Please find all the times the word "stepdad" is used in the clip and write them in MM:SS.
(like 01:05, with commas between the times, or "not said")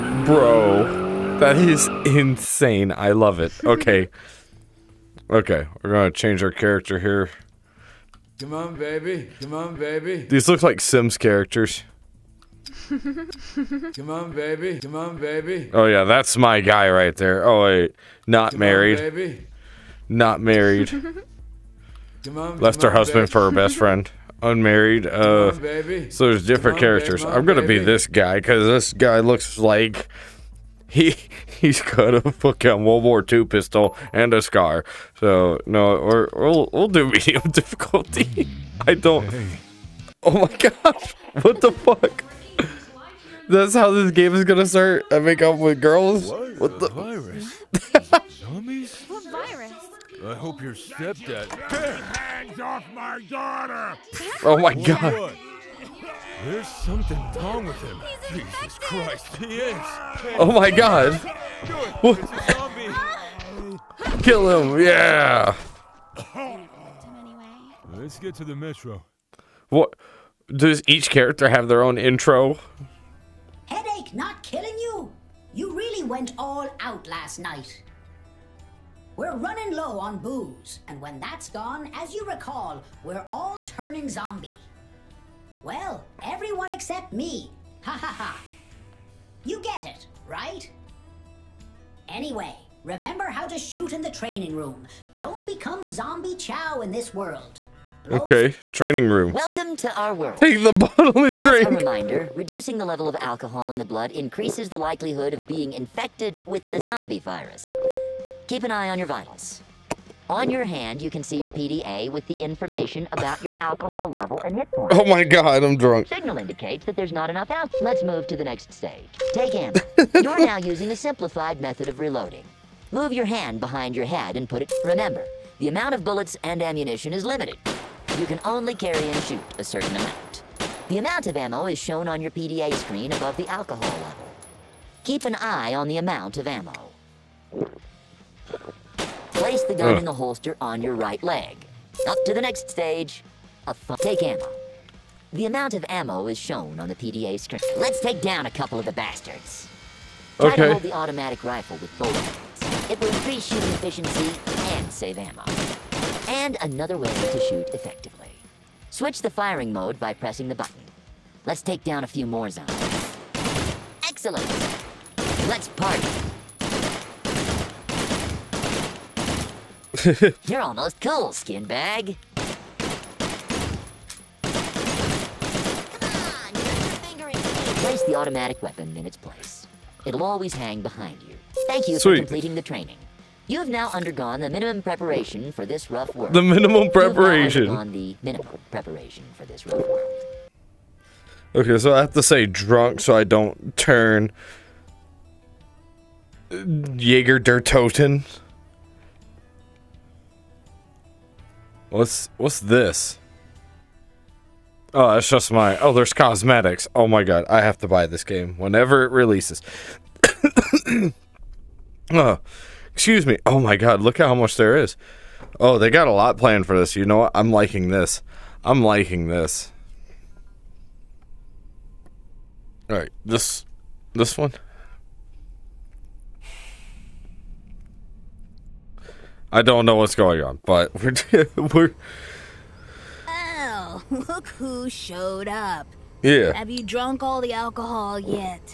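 00:50.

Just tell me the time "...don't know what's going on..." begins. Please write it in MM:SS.
03:49.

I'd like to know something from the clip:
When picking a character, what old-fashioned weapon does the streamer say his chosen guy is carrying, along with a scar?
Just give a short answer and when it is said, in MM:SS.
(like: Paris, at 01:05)
World War II pistol, at 00:32.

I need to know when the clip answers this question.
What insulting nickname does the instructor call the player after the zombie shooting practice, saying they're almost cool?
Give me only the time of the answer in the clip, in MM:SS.
02:51.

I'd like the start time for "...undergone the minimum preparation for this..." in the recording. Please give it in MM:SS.
03:03.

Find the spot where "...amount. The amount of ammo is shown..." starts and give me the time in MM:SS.
02:09.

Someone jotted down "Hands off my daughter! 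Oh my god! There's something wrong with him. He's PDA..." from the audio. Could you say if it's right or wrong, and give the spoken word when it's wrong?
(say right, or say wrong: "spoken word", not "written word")
wrong: "Jesus", not "PDA".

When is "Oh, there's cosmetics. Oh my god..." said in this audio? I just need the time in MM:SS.
03:25.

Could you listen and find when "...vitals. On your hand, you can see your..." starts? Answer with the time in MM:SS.
01:49.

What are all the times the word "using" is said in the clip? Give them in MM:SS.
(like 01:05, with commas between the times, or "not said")
02:00.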